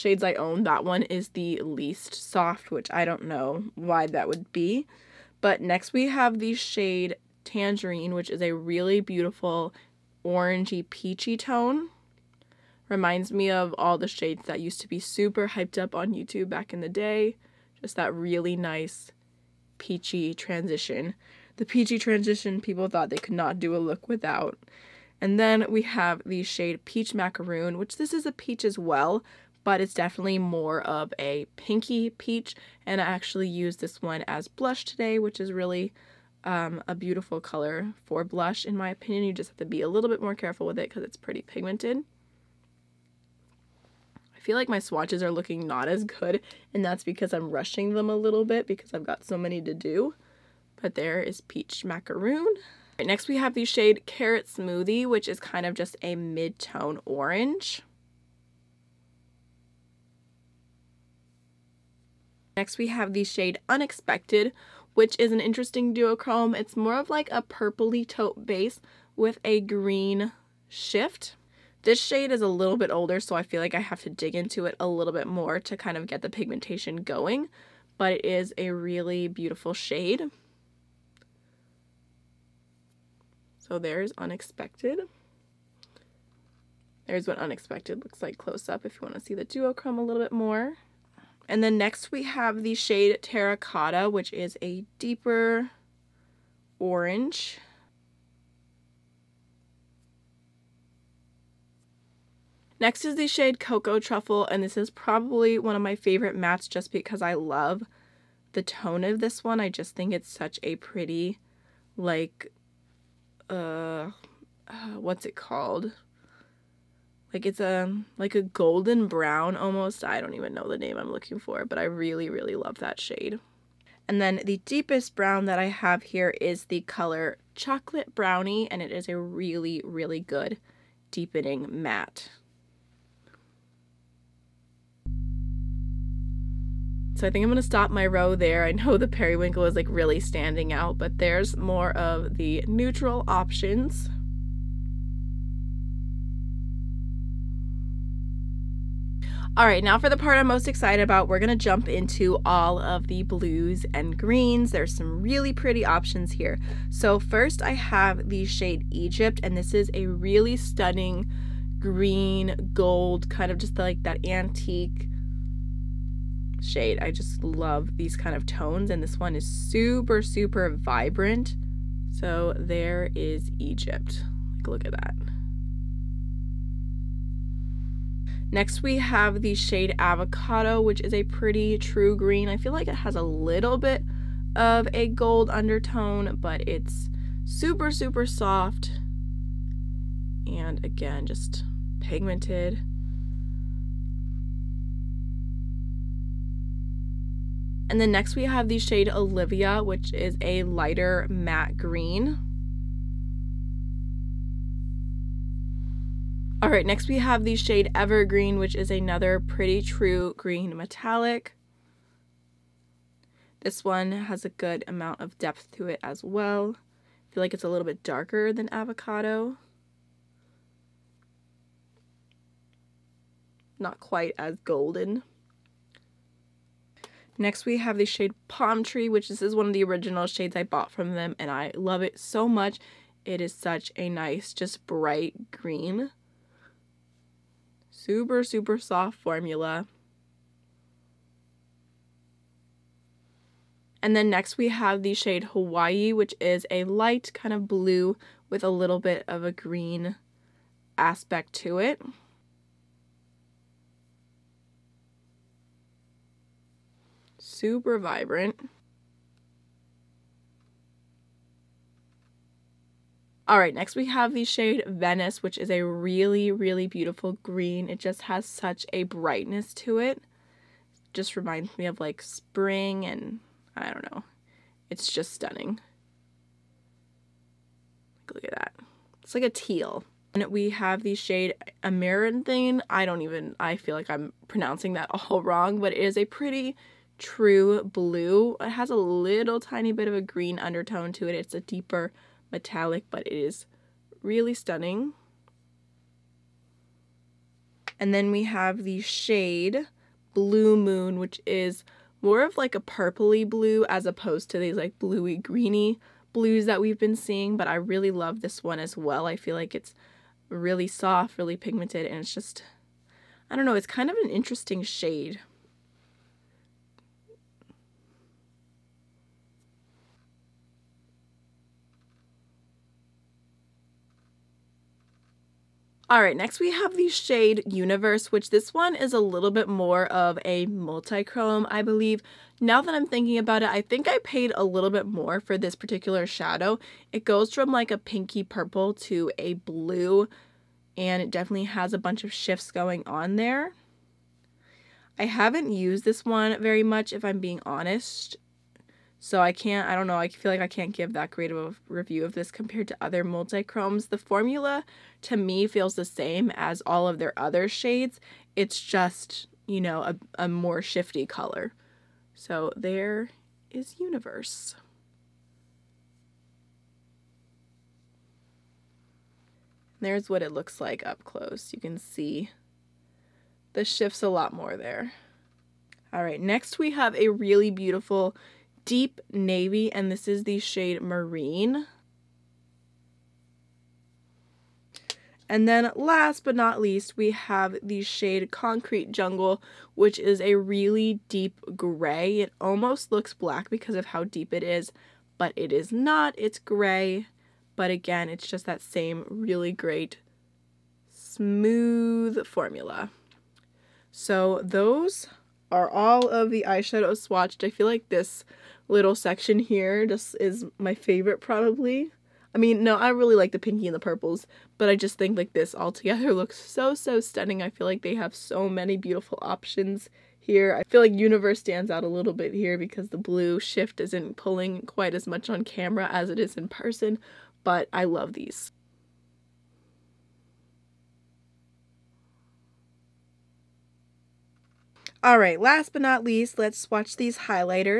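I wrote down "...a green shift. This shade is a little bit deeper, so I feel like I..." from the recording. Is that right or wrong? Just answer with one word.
wrong.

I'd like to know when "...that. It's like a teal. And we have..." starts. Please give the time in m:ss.
4:38.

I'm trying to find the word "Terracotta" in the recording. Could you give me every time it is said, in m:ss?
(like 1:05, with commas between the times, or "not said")
1:33.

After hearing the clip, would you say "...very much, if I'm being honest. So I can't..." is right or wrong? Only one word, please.
right.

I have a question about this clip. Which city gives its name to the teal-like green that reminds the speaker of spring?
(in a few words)
Venice.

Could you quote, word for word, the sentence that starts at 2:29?
All right, now for the part I'm most excited about, we're gonna jump into all of the blues and greens.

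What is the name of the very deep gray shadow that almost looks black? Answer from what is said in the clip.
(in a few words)
Concrete Jungle.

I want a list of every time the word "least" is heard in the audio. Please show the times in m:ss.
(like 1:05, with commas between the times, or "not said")
0:01, 6:26, 7:16.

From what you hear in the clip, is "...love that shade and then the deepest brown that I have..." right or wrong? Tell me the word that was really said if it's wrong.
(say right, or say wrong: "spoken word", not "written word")
right.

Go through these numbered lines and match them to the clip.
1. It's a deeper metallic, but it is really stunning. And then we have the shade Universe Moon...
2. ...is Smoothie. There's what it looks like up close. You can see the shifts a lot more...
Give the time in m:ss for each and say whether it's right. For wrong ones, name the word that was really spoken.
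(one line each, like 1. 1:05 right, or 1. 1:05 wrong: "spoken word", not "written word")
1. 4:51 wrong: "Blue", not "Universe"
2. 6:03 wrong: "Universe", not "Smoothie".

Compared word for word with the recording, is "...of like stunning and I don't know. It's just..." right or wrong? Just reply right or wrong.
wrong.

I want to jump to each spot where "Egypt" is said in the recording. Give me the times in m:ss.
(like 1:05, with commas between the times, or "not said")
2:38, 2:53.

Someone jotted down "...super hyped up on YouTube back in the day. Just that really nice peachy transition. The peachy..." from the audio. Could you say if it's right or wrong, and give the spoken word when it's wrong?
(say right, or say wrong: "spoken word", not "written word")
right.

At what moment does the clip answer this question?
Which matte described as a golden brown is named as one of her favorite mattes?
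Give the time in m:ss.
1:43.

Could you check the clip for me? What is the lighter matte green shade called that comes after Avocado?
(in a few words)
Olivia.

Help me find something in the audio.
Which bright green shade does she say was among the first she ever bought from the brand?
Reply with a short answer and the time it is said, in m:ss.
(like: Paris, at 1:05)
Palm Tree, at 3:48.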